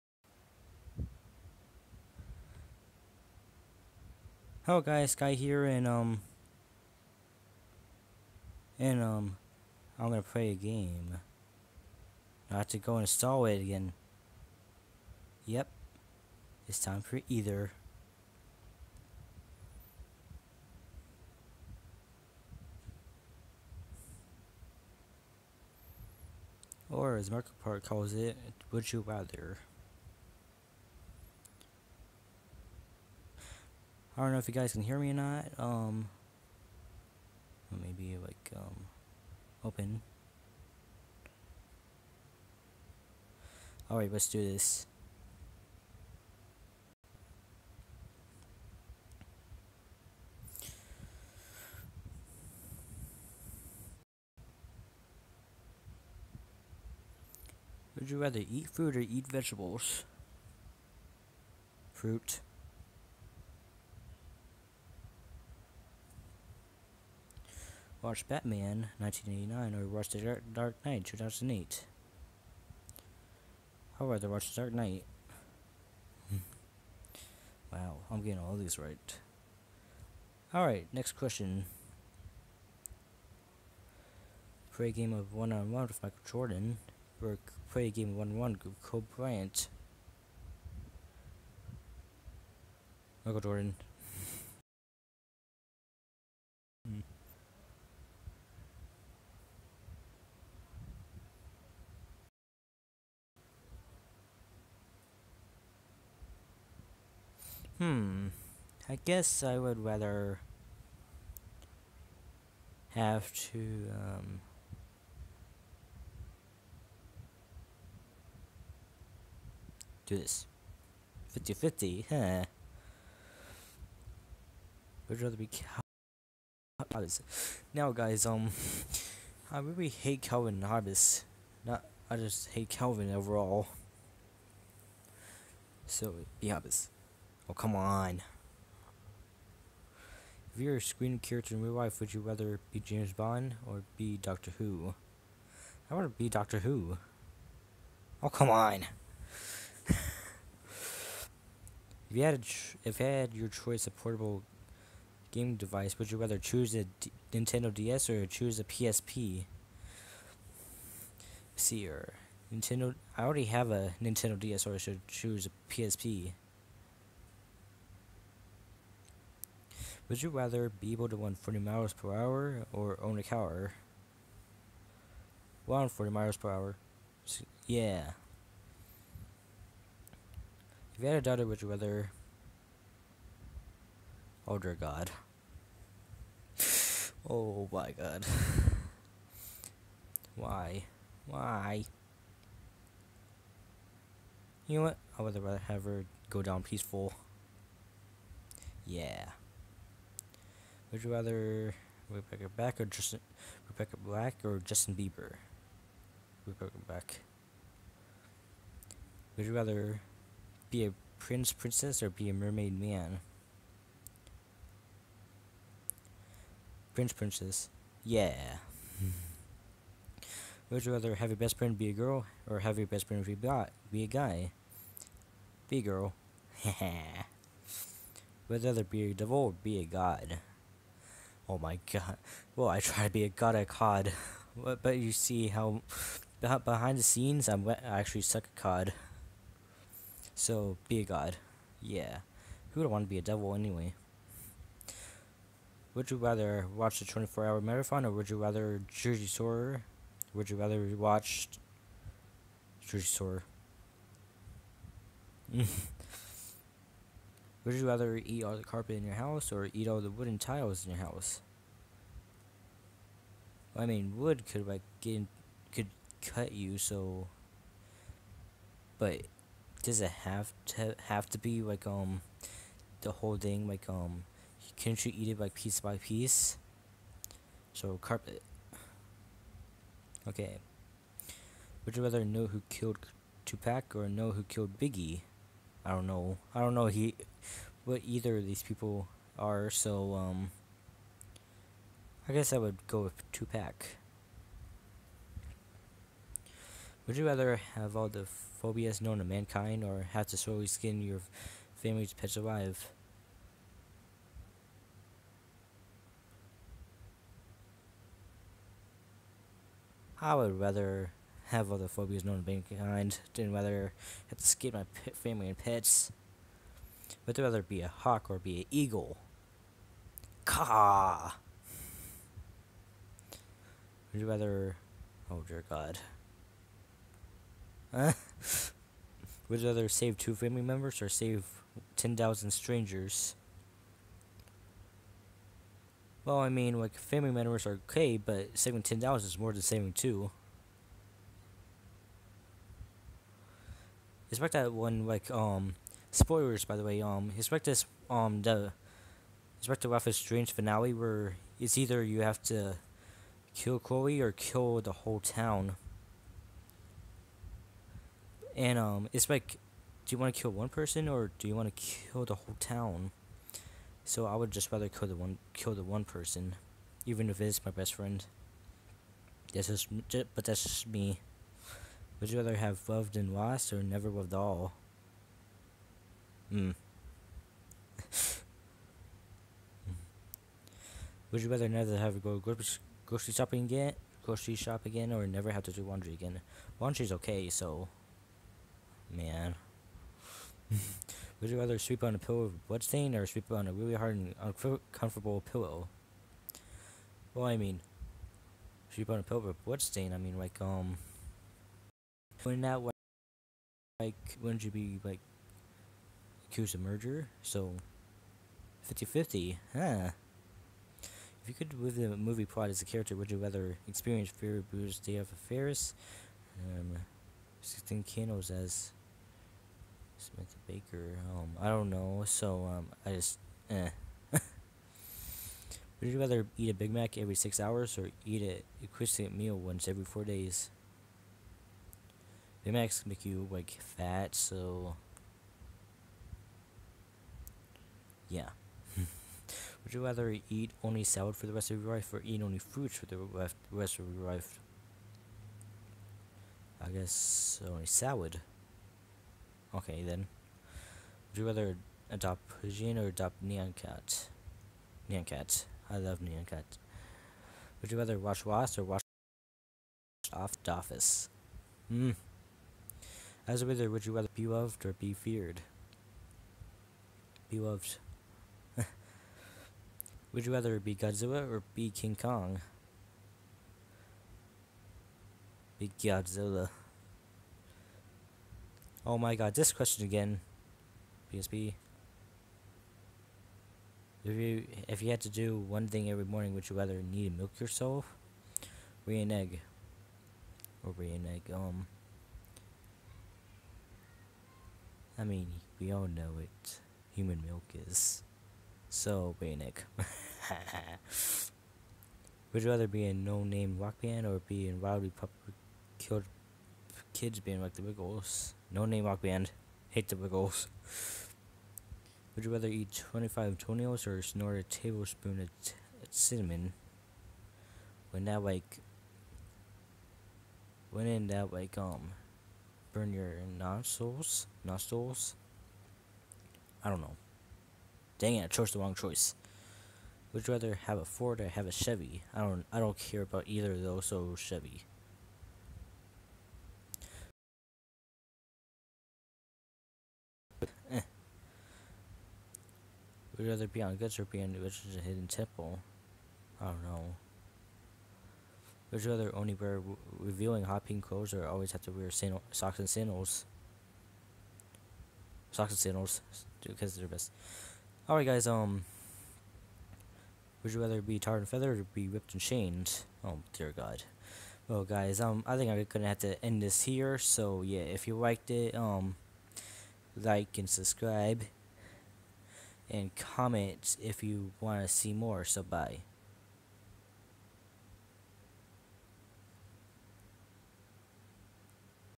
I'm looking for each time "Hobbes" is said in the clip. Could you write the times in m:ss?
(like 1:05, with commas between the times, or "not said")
2:10, 2:16.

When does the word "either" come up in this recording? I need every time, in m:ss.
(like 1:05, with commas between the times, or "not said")
0:17, 4:48, 5:51, 8:53.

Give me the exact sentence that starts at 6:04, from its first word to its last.
So I would just rather kill the one kill the one person, even if it's my best friend.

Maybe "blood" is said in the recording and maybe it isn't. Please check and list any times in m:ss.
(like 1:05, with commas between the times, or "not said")
6:32, 6:39.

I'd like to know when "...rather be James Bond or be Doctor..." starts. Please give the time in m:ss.
2:22.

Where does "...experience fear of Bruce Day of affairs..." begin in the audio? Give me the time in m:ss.
6:53.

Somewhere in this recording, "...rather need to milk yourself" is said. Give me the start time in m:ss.
8:06.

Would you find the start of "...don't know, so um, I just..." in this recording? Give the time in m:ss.
7:01.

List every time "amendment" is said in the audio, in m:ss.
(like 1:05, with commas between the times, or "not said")
not said.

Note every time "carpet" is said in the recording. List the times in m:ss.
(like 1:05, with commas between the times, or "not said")
4:18, 4:38.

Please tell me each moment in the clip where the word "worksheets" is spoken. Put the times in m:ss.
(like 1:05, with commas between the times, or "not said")
not said.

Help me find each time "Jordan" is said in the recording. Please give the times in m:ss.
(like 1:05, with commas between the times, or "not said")
1:26, 1:33.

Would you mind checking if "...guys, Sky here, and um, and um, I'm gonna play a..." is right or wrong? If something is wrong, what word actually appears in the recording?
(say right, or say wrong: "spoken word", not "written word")
right.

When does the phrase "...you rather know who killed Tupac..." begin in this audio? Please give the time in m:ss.
4:41.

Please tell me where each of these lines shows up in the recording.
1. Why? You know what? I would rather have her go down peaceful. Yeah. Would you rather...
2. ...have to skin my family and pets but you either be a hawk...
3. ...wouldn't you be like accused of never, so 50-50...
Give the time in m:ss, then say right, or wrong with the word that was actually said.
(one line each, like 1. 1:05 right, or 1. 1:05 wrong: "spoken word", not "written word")
1. 3:11 right
2. 5:14 wrong: "rather", not "either"
3. 6:44 wrong: "murder", not "never".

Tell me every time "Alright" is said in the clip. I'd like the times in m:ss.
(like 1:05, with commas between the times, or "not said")
1:20, 9:18.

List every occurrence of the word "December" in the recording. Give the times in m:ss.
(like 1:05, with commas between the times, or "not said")
not said.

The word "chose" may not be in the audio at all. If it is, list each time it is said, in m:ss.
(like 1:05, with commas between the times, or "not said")
8:48.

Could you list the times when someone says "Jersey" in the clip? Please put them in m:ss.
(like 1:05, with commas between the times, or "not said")
4:08, 4:12.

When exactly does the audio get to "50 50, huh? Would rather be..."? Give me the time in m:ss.
2:01.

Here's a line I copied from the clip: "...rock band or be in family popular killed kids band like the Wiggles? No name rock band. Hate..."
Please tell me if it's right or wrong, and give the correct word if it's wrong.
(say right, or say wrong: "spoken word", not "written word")
wrong: "wildly", not "family".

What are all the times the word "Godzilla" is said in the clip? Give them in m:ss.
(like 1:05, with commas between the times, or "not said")
7:50, 7:55.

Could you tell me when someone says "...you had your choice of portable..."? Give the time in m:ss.
2:33.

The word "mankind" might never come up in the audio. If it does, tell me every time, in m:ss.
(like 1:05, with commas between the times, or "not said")
4:59, 5:12.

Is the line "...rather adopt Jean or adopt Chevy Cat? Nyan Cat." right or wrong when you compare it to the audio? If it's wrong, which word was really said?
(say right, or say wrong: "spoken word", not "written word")
wrong: "Nyan", not "Chevy".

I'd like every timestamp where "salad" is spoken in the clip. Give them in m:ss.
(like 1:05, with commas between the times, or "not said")
7:21, 7:27.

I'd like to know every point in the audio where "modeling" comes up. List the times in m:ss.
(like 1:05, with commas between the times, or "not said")
not said.